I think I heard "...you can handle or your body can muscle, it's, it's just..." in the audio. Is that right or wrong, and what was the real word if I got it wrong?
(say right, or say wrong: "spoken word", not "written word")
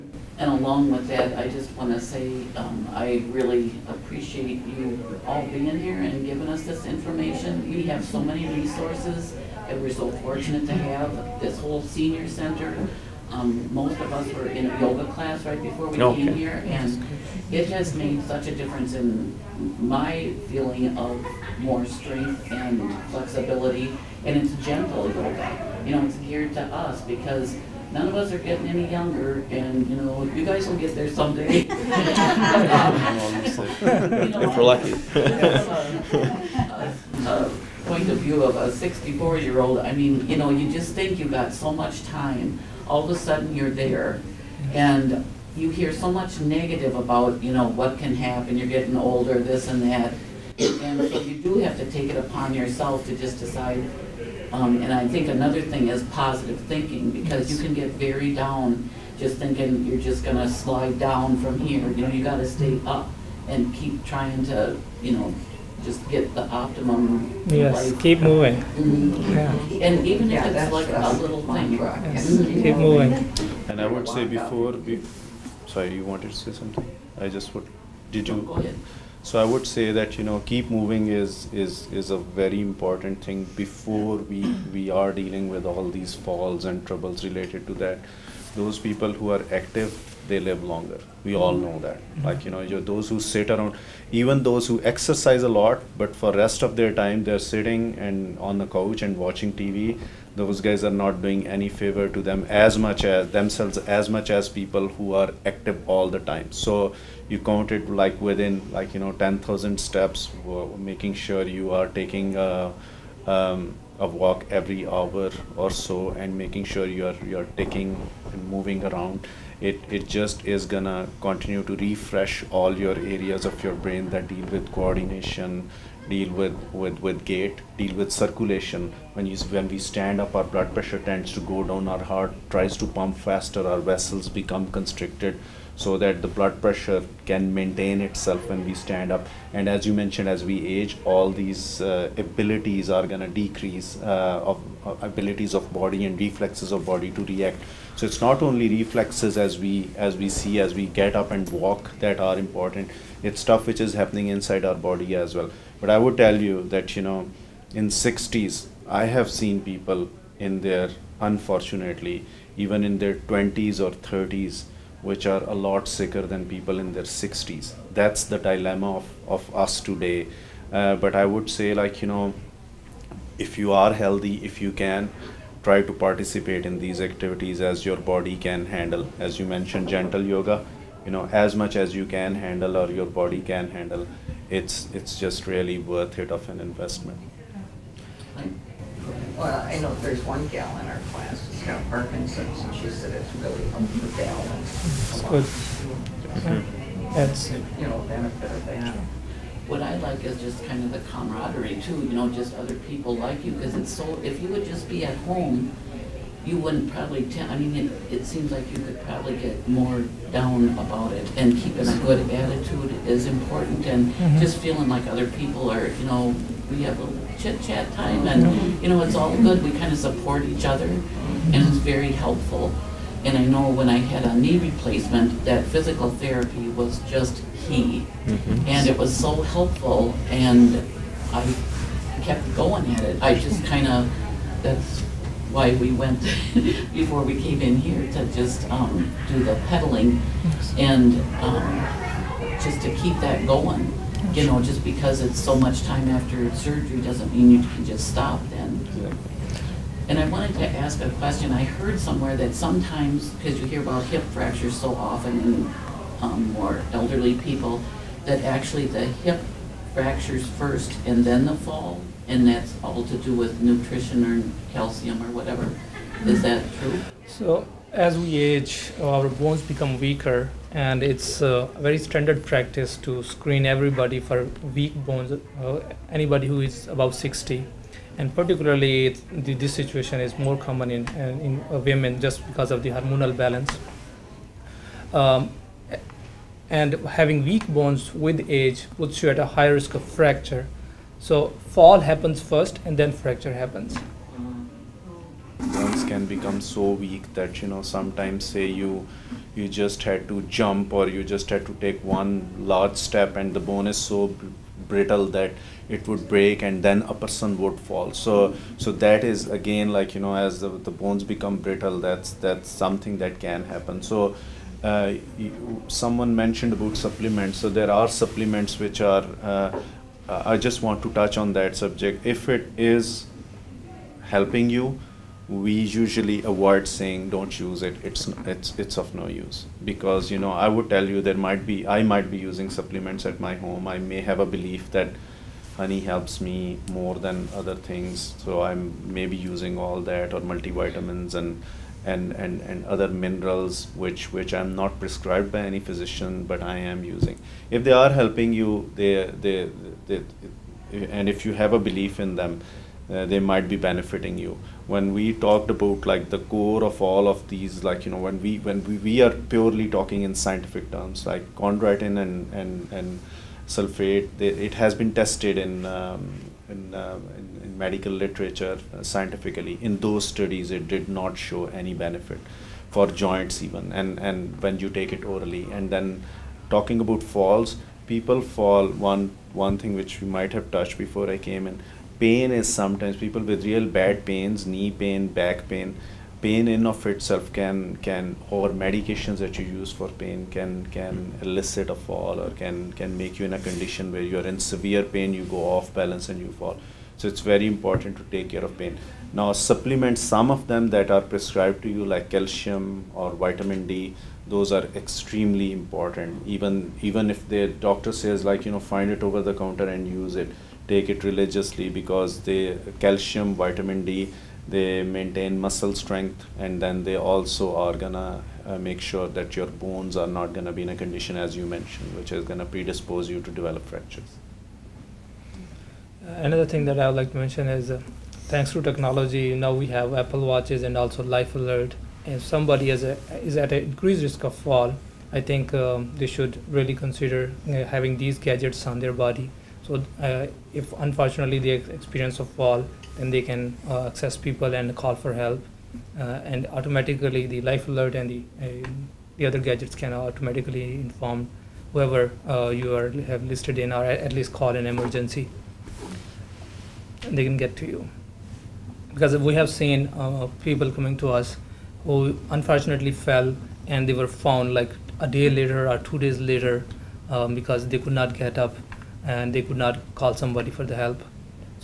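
wrong: "handle", not "muscle".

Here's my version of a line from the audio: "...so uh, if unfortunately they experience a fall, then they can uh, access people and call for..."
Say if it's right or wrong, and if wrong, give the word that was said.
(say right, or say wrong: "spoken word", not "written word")
right.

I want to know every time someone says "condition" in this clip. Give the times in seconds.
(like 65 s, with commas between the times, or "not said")
393 s, 421 s.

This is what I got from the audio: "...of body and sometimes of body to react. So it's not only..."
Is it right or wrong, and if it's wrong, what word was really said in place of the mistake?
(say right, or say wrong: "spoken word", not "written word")
wrong: "reflexes", not "sometimes".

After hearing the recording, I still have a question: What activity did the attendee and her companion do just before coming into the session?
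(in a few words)
Pedaling.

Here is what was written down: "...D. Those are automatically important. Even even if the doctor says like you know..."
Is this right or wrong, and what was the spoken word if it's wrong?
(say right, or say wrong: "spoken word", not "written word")
wrong: "extremely", not "automatically".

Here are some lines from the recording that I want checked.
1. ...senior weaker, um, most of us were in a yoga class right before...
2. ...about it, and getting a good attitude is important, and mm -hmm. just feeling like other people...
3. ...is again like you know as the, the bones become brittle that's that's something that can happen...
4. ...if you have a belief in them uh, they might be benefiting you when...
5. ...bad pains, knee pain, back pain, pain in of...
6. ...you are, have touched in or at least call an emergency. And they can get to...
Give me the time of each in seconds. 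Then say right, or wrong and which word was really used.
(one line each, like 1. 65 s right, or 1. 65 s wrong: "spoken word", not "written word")
1. 11 s wrong: "center", not "weaker"
2. 210 s wrong: "keeping", not "getting"
3. 309 s right
4. 351 s right
5. 383 s right
6. 452 s wrong: "listed", not "touched".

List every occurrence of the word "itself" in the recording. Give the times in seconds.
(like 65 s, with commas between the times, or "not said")
138 s, 387 s.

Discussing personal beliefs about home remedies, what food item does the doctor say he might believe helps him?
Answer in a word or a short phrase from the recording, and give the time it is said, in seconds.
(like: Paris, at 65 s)
Honey, at 335 s.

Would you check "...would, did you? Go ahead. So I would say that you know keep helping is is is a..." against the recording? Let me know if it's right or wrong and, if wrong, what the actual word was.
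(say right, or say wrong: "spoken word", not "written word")
wrong: "moving", not "helping".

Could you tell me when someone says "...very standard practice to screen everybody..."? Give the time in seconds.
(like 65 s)
271 s.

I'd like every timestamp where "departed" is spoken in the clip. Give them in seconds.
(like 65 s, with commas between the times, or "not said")
not said.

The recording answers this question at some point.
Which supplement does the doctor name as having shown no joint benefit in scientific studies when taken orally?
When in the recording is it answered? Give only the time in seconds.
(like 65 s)
361 s.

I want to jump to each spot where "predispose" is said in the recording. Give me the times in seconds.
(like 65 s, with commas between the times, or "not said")
422 s.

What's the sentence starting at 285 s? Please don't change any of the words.
Um, and having weak bones with age puts you at a high risk of fracture.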